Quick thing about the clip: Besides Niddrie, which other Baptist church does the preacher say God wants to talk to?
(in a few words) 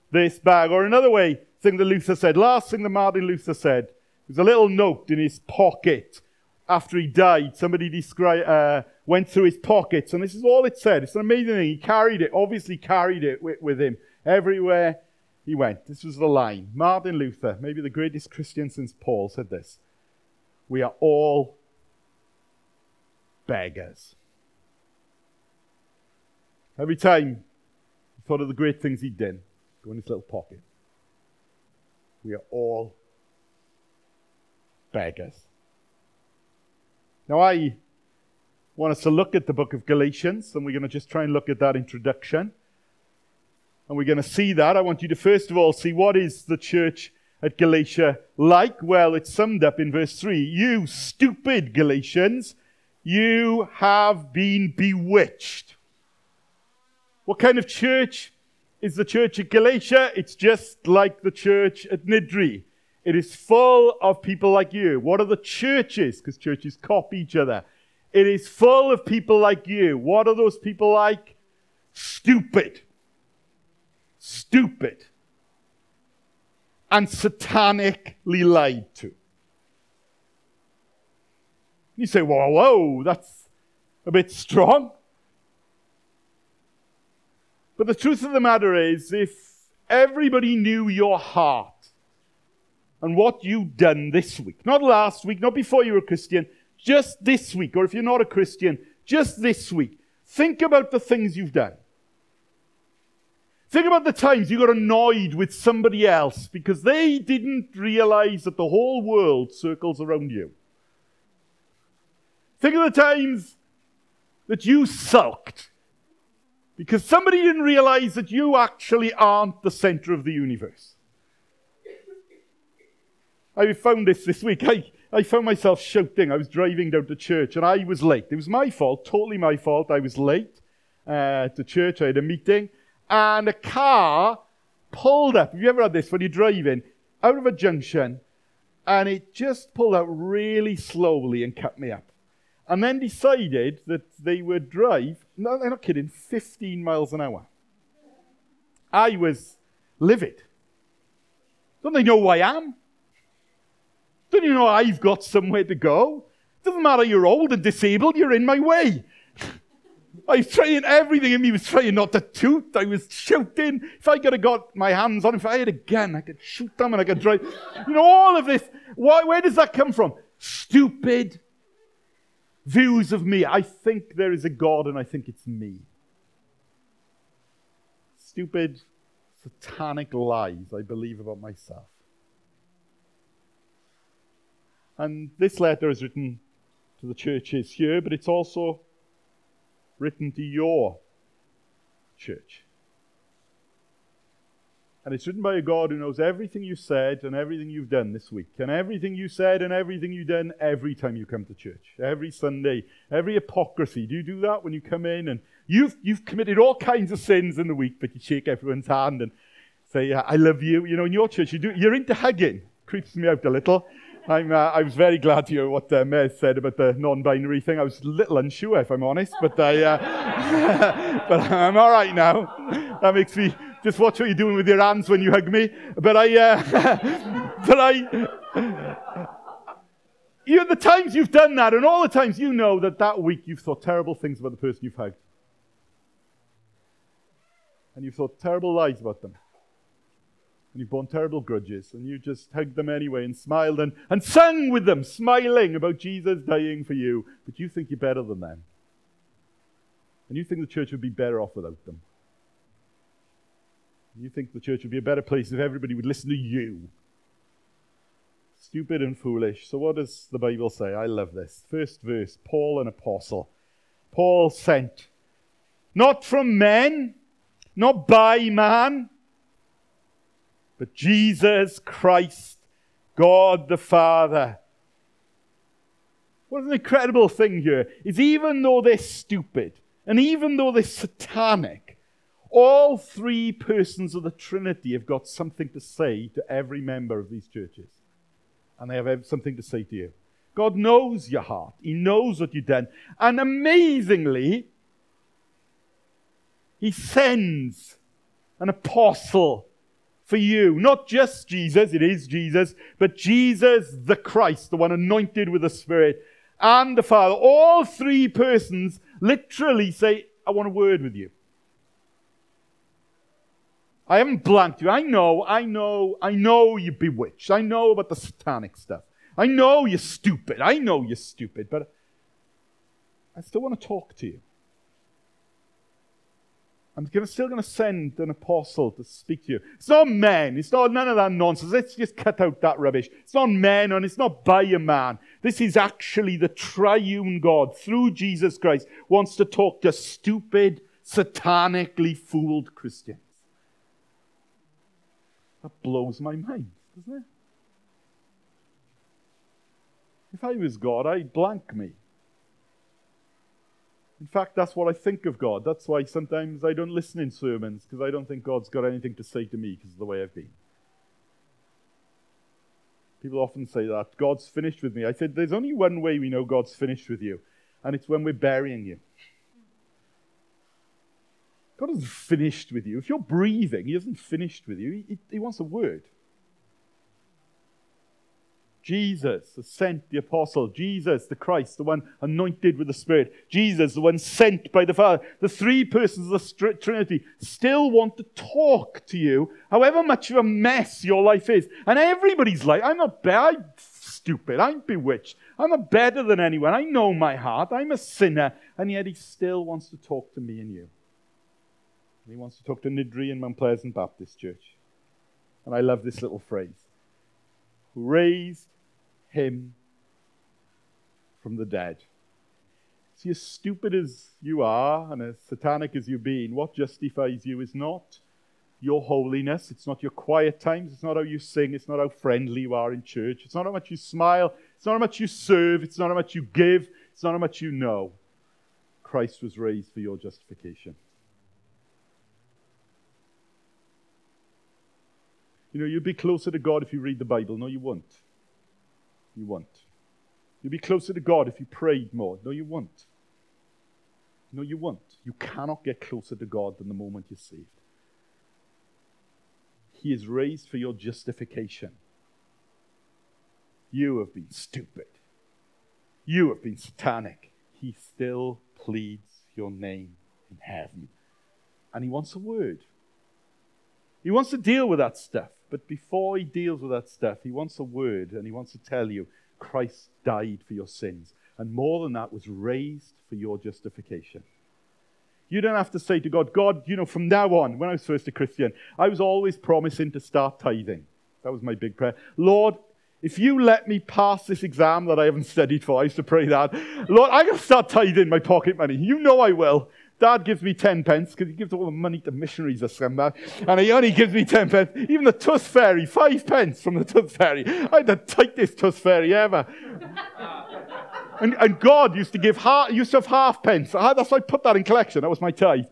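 Mount Pleasant Baptist Church.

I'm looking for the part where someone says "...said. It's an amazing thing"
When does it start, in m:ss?
0:10.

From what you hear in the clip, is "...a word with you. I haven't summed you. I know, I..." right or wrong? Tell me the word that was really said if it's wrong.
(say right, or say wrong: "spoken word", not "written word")
wrong: "blanked", not "summed".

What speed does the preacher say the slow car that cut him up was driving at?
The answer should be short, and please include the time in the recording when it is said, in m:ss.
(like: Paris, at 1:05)
15 miles an hour, at 2:26.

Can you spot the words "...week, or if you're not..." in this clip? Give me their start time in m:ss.
1:37.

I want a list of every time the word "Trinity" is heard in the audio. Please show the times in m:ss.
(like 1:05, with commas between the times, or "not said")
4:44, 6:26.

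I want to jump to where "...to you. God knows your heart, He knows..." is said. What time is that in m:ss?
4:49.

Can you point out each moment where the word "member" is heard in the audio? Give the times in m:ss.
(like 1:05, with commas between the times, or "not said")
4:46.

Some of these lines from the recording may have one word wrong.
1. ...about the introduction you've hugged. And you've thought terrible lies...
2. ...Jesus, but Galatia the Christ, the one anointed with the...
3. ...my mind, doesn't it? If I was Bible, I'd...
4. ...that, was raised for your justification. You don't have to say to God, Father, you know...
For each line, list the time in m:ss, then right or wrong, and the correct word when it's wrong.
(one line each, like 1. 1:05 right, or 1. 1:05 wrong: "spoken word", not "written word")
1. 3:54 wrong: "person", not "introduction"
2. 5:02 wrong: "Jesus", not "Galatia"
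3. 5:46 wrong: "God", not "Bible"
4. 7:52 wrong: "God", not "Father".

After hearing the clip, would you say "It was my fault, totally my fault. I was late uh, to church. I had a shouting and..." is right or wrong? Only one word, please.
wrong.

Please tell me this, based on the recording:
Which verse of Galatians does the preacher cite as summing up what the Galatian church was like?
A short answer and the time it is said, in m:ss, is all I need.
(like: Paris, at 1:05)
Verse 3, at 0:49.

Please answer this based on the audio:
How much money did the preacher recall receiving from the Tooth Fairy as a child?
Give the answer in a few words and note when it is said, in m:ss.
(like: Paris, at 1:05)
5 pence, at 8:16.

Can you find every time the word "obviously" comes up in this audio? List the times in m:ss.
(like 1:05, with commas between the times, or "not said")
0:12.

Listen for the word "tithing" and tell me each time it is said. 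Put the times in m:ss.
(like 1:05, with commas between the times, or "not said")
8:00, 8:07.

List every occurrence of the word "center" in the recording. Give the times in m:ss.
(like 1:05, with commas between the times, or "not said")
1:59.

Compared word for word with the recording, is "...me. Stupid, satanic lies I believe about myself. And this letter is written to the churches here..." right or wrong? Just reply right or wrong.
right.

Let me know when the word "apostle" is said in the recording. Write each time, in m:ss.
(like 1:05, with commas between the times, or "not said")
4:22, 4:58, 5:28, 6:20.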